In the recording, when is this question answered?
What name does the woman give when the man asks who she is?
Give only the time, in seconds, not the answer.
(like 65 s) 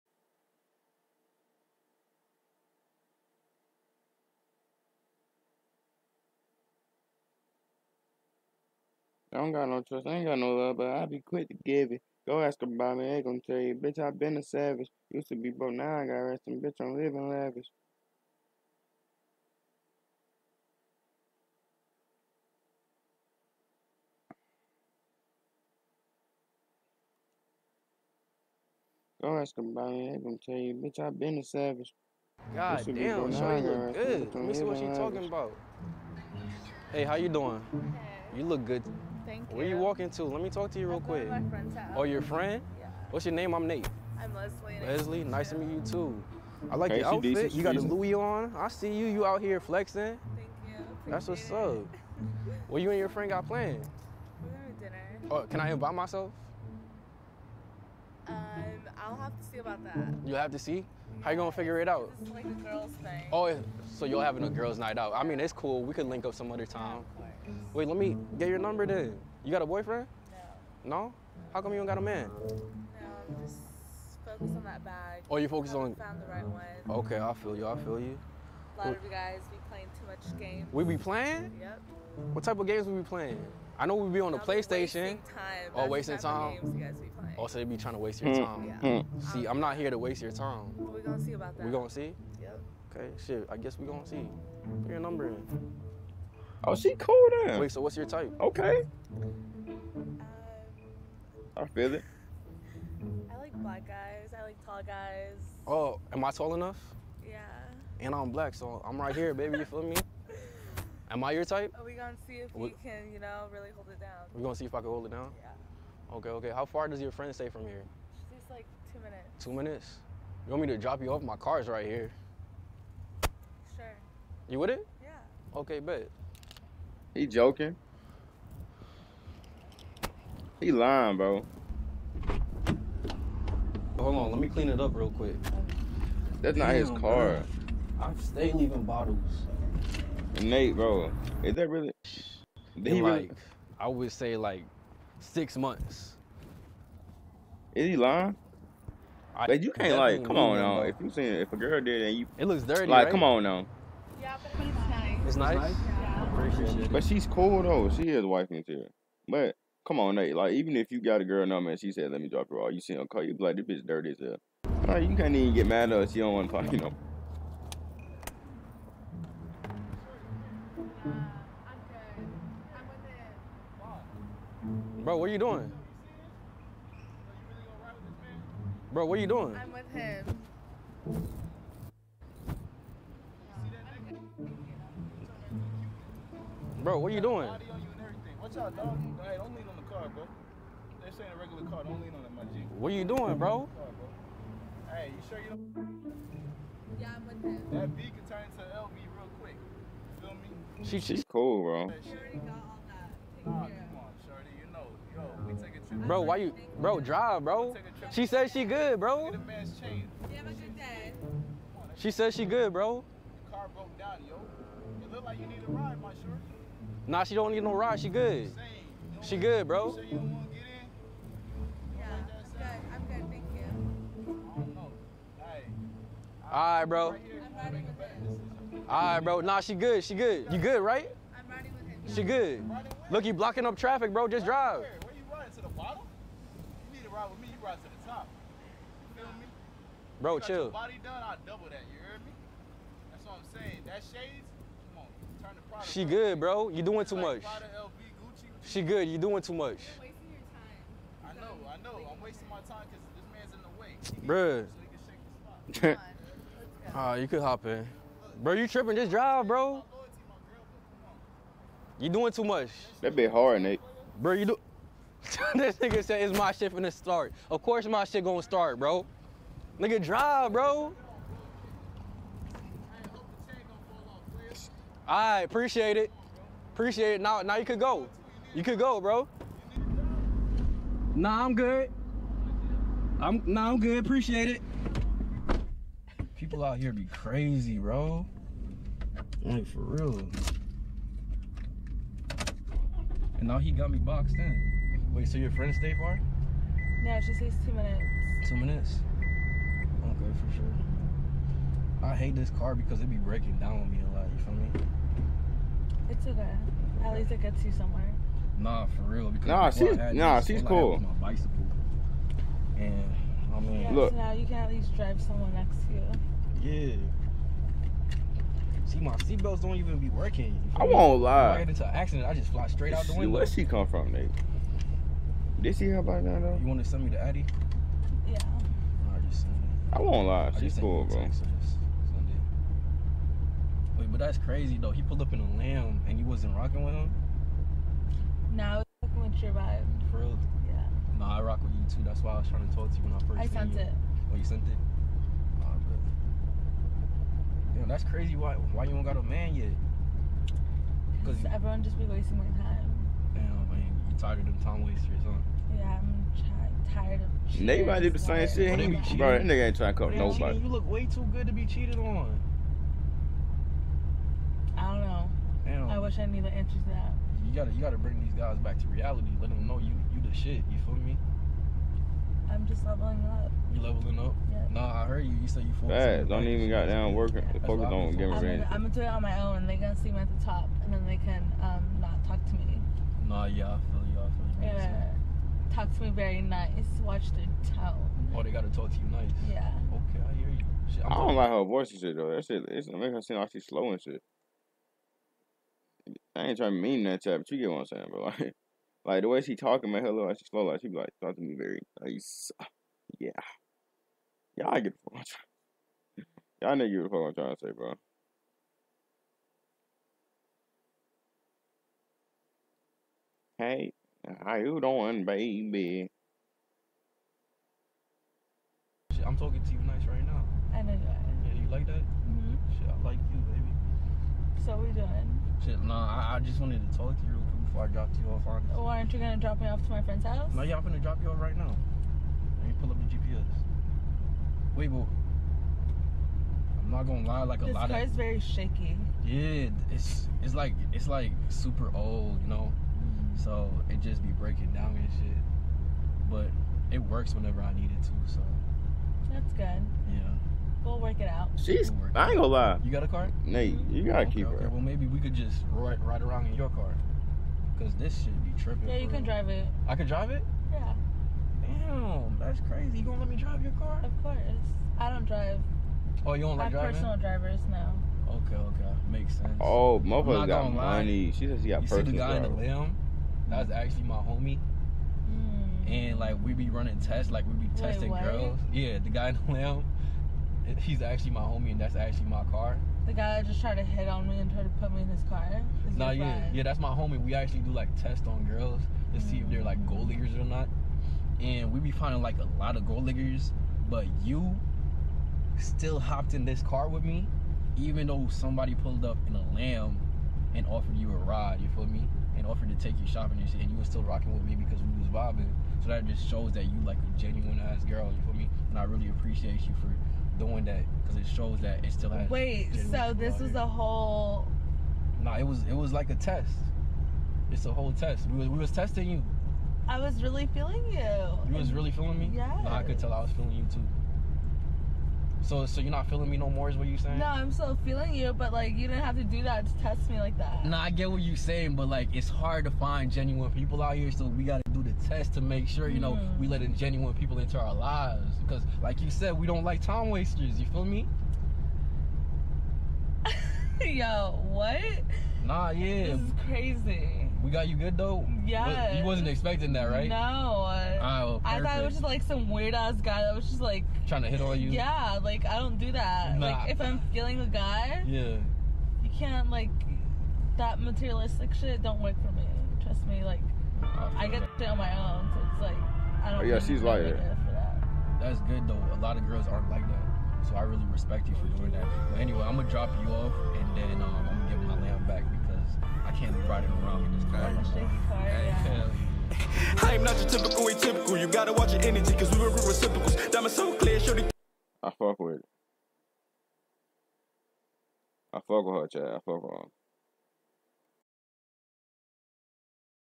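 44 s.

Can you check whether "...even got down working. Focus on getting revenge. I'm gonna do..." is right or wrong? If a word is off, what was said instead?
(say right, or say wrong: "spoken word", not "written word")
right.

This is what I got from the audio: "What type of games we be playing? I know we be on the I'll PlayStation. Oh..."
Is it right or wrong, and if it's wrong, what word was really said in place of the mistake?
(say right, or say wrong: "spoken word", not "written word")
right.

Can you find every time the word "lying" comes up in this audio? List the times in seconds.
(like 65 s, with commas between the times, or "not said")
130 s, 147 s.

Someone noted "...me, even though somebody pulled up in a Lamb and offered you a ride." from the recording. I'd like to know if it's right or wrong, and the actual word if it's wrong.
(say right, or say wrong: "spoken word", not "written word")
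right.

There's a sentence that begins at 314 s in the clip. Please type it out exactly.
So now you can at least drive someone next to you.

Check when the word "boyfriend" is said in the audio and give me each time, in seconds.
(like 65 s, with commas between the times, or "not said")
69 s.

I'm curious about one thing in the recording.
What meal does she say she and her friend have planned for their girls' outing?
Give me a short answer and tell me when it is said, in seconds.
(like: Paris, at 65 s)
Dinner, at 54 s.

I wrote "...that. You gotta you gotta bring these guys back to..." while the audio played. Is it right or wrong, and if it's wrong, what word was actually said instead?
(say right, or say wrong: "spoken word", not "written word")
right.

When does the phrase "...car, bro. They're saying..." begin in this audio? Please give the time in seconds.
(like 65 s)
189 s.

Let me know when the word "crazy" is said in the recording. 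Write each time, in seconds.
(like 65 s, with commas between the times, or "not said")
287 s, 334 s, 348 s, 462 s, 546 s.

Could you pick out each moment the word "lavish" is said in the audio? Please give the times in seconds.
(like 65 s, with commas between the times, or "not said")
17 s, 34 s.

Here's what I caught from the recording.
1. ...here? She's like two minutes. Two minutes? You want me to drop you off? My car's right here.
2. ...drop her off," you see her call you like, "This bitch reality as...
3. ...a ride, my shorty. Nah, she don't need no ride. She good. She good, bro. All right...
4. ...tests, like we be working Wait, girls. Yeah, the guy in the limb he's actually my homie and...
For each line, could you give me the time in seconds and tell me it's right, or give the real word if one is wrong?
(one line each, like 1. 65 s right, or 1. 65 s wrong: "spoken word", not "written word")
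1. 117 s right
2. 162 s wrong: "dirty", not "reality"
3. 215 s right
4. 476 s wrong: "testing", not "working".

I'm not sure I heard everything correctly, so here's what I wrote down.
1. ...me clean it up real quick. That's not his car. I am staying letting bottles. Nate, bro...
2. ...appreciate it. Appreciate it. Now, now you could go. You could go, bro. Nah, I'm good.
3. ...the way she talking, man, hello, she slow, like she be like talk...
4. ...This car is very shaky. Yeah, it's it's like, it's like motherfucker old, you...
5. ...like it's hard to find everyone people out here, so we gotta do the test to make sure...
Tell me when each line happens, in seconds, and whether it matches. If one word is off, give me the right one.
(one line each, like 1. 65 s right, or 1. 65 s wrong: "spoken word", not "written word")
1. 134 s wrong: "leaving", not "letting"
2. 275 s right
3. 399 s right
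4. 437 s wrong: "super", not "motherfucker"
5. 531 s wrong: "genuine", not "everyone".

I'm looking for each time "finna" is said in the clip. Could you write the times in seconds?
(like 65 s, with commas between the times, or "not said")
430 s.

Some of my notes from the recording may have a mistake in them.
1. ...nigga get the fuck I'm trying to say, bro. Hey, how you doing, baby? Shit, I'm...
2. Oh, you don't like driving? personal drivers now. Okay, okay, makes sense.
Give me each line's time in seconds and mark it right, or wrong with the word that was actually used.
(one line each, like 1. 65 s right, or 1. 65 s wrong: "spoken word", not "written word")
1. 406 s right
2. 466 s right.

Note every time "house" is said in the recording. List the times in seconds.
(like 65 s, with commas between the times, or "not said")
41 s, 430 s.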